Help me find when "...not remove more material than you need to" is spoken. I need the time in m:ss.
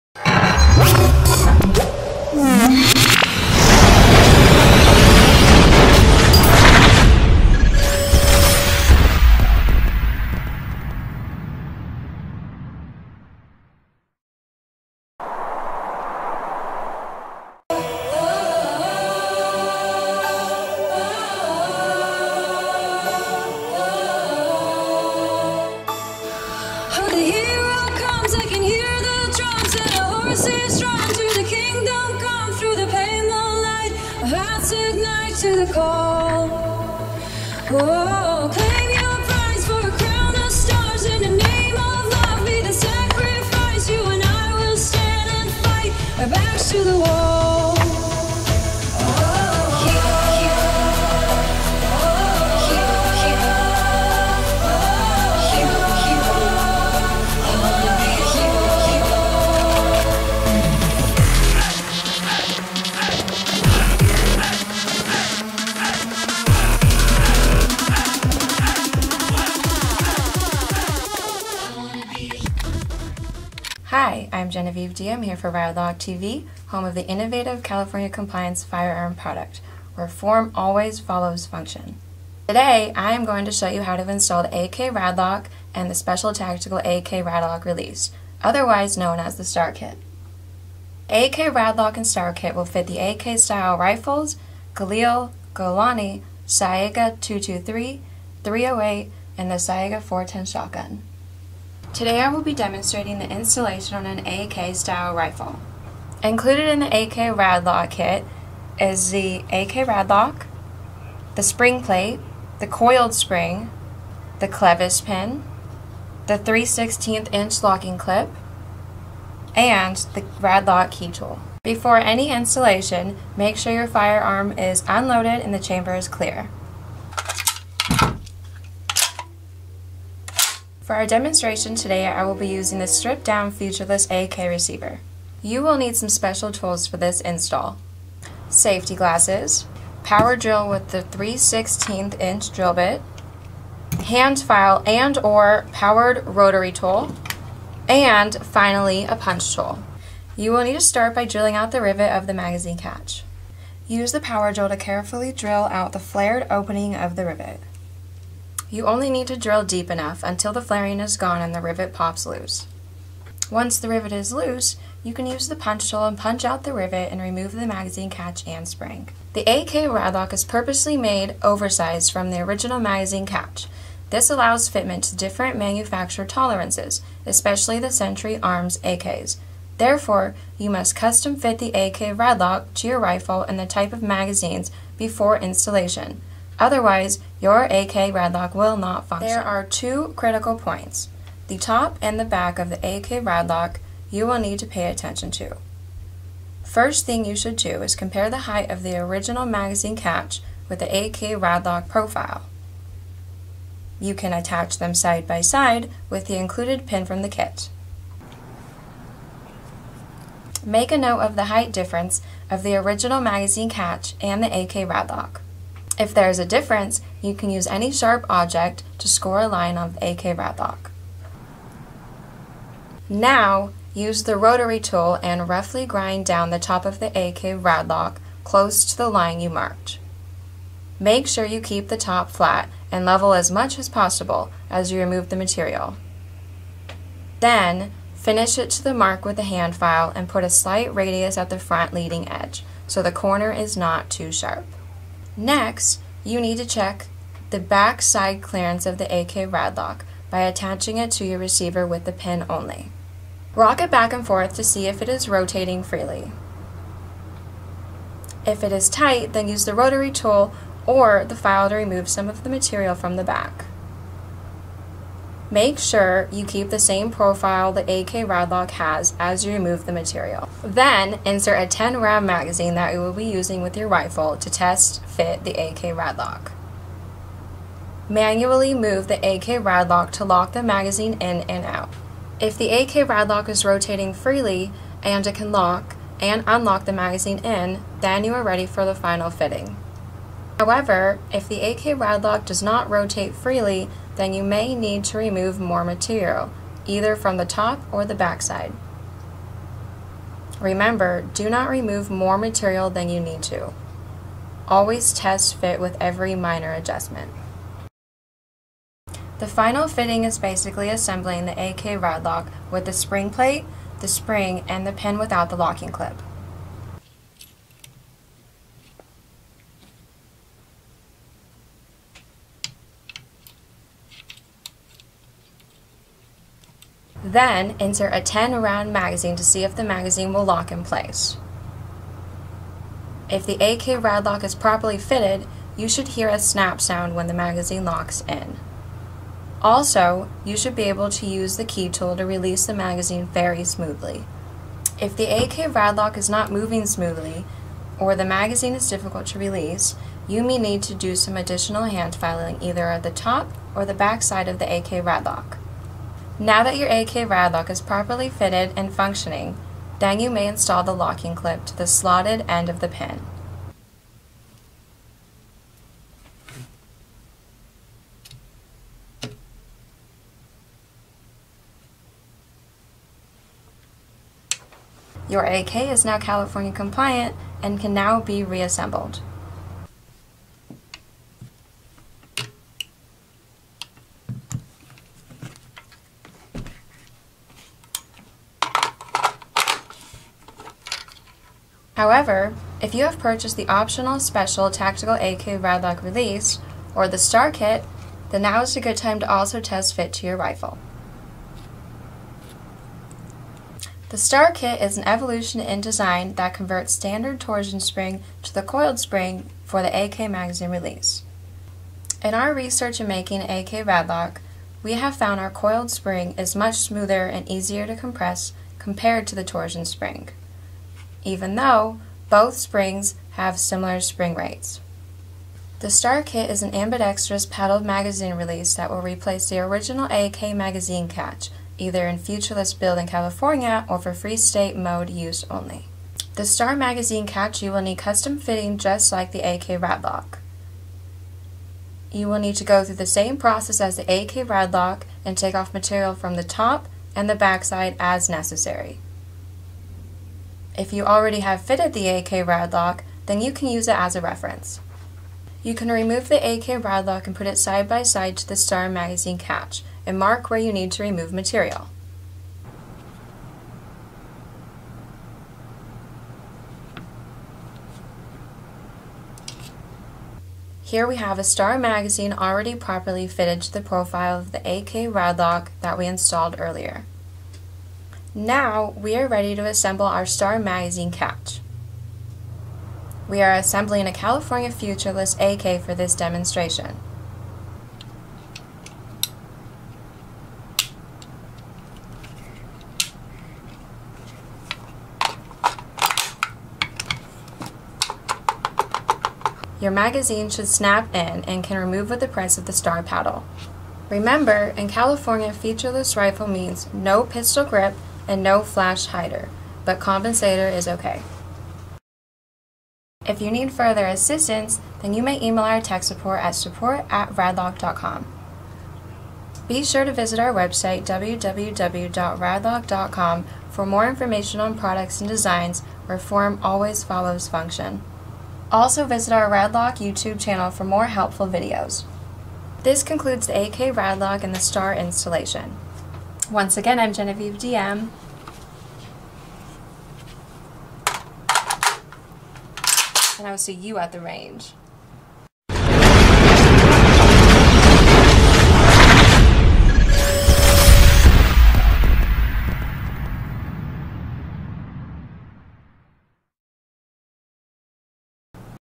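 5:01.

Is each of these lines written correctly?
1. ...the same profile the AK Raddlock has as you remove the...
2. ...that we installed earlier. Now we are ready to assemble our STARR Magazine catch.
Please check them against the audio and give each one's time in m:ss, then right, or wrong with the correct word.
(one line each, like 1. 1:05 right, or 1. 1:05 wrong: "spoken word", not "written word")
1. 4:26 right
2. 7:55 right.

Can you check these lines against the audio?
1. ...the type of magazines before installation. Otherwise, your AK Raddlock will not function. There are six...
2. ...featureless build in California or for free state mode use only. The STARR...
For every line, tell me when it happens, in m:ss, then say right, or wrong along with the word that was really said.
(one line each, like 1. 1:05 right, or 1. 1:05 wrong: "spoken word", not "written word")
1. 3:03 wrong: "two", not "six"
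2. 7:12 right.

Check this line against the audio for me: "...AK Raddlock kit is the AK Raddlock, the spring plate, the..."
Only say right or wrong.
right.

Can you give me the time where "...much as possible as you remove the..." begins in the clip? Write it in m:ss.
3:53.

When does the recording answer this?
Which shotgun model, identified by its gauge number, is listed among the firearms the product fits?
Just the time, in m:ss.
1:39.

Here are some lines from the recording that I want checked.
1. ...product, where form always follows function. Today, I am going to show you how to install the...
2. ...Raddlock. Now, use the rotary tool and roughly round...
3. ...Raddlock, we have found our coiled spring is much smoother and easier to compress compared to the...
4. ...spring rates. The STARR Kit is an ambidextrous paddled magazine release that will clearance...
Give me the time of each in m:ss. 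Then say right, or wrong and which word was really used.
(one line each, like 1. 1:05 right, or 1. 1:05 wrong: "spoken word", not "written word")
1. 1:19 right
2. 3:40 wrong: "grind", not "round"
3. 6:53 right
4. 7:03 wrong: "replace", not "clearance".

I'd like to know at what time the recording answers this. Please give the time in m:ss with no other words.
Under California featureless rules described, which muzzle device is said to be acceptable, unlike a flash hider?
8:29.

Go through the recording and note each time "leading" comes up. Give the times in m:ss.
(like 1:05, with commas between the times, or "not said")
4:01.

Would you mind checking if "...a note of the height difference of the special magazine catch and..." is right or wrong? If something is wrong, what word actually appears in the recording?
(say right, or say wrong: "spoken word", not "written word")
wrong: "original", not "special".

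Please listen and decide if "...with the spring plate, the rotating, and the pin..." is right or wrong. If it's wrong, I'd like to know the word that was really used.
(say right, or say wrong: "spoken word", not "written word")
wrong: "spring", not "rotating".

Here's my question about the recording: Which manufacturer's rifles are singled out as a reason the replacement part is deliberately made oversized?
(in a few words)
Century Arms.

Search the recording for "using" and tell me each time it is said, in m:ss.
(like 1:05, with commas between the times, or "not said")
2:12, 4:33.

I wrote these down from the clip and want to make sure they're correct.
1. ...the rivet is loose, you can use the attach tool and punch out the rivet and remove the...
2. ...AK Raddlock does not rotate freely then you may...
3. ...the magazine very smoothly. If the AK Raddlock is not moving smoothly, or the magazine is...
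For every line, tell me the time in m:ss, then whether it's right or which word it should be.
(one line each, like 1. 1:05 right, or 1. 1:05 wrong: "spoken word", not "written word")
1. 2:43 wrong: "punch", not "attach"
2. 4:51 right
3. 5:42 right.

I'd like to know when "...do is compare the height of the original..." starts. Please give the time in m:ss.
3:17.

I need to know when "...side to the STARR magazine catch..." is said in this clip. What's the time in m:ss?
7:38.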